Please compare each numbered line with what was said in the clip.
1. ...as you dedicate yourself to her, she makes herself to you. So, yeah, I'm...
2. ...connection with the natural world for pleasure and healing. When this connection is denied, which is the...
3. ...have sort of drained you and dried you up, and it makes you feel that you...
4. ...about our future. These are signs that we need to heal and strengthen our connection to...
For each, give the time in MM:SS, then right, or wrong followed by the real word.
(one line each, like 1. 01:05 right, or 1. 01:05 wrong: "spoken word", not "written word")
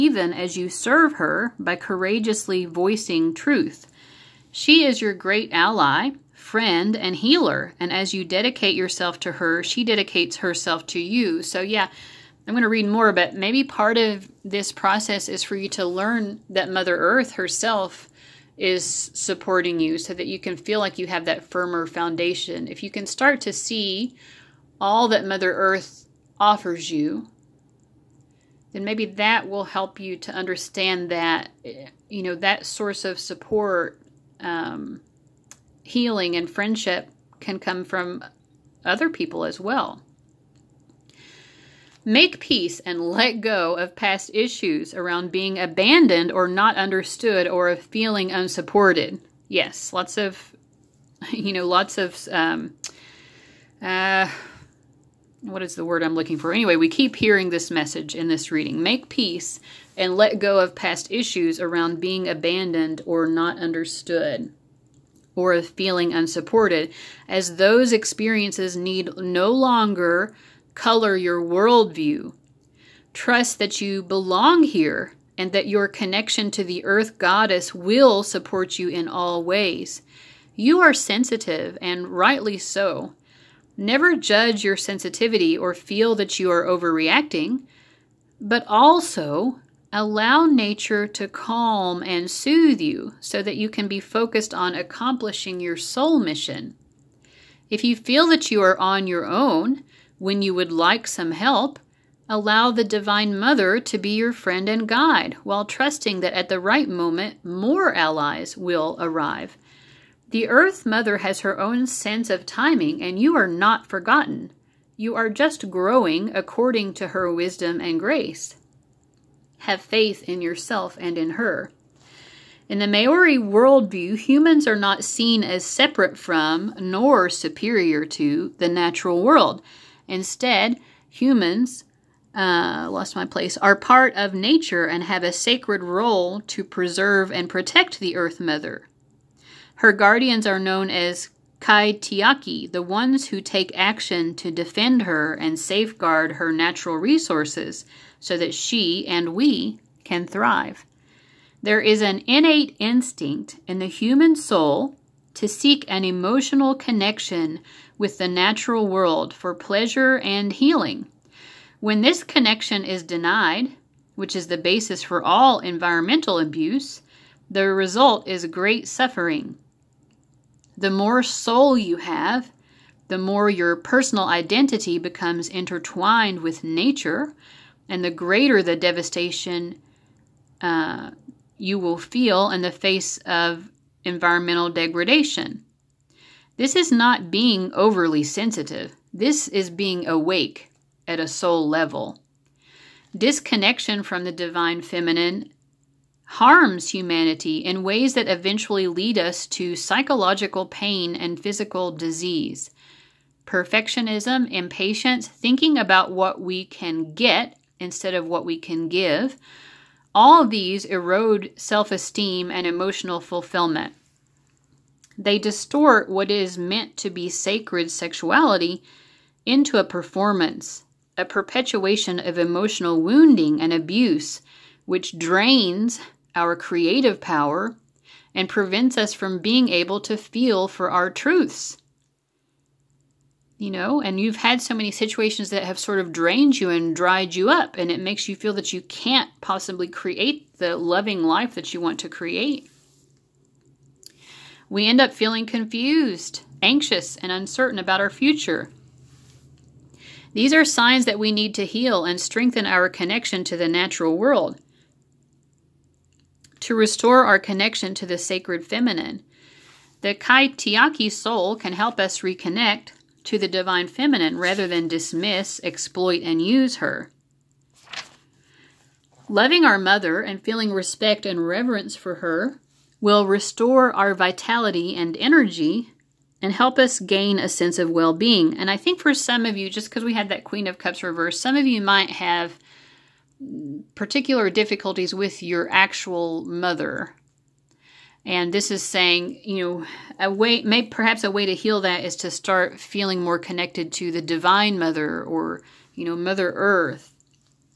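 1. 00:07 wrong: "dedicates", not "makes"
2. 02:36 right
3. 03:55 right
4. 04:07 right.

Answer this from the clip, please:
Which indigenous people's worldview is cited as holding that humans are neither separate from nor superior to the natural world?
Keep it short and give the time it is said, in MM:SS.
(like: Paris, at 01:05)
Maori, at 02:02.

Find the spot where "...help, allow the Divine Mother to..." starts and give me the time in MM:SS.
01:41.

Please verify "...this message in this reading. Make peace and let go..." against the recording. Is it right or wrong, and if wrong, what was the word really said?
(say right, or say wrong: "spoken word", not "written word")
right.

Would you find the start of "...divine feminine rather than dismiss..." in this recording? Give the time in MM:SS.
04:23.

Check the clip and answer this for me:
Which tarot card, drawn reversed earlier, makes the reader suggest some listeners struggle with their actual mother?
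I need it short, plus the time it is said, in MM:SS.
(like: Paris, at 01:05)
Queen of Cups, at 04:40.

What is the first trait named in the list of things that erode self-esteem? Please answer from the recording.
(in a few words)
Perfectionism.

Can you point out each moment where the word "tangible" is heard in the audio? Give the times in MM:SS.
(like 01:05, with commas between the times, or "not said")
not said.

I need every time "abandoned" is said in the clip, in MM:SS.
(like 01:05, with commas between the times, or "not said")
00:45, 01:02.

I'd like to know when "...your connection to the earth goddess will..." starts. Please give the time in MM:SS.
01:15.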